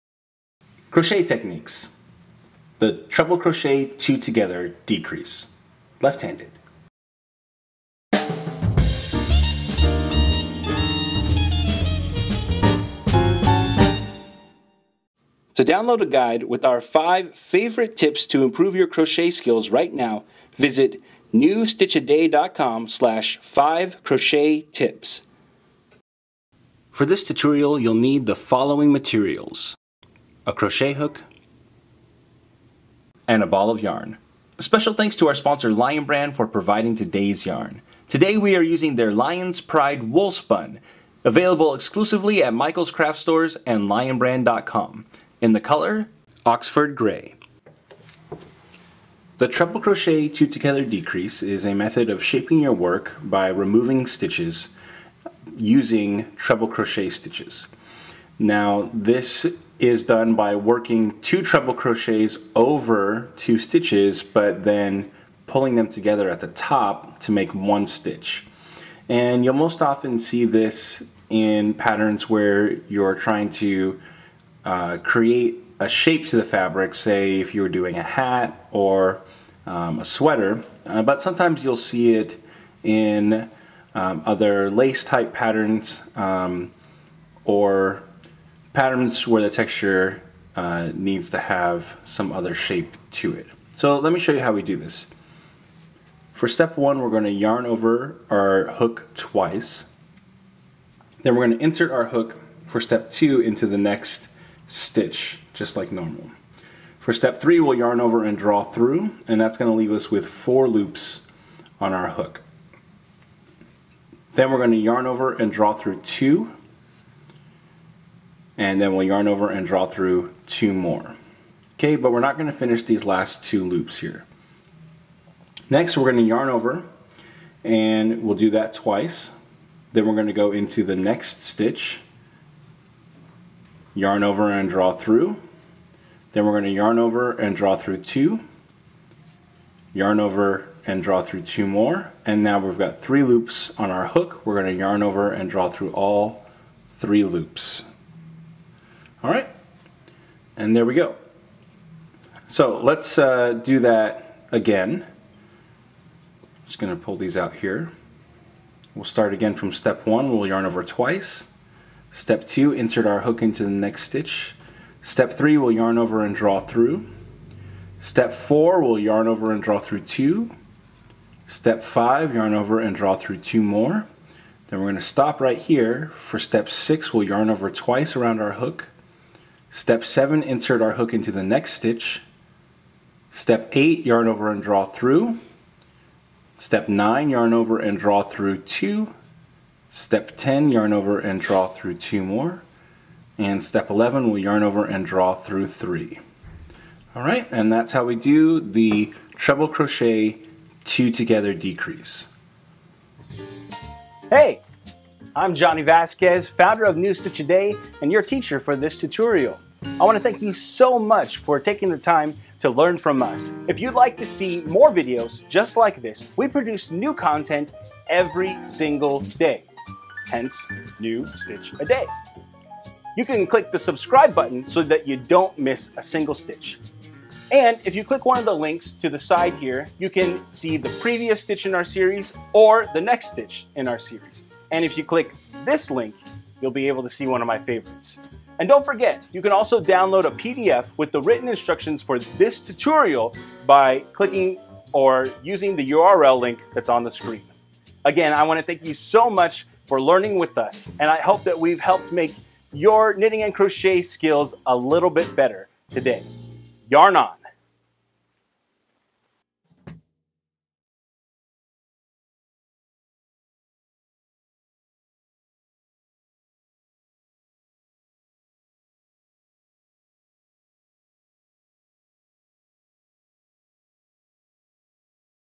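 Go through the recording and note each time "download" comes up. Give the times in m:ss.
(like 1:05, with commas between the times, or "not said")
0:15, 3:59.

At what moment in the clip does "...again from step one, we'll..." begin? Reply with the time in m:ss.
2:39.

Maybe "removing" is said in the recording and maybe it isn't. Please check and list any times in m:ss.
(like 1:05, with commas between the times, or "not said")
0:53.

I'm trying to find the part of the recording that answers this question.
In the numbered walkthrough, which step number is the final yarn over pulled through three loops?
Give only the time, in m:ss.
3:13.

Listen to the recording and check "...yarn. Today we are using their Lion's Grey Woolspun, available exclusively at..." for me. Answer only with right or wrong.
wrong.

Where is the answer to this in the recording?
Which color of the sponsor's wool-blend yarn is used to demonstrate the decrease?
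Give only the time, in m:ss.
0:46.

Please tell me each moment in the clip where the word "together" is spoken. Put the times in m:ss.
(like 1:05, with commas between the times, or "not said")
0:04, 0:50, 1:05, 3:21.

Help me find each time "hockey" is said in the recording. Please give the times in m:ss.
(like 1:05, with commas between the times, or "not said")
not said.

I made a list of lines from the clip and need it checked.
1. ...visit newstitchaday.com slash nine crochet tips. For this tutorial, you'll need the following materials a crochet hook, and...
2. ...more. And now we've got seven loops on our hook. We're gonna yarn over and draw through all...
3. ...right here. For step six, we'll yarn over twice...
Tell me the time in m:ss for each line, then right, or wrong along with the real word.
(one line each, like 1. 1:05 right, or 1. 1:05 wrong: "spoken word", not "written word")
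1. 0:20 wrong: "five", not "nine"
2. 2:21 wrong: "three", not "seven"
3. 2:55 right.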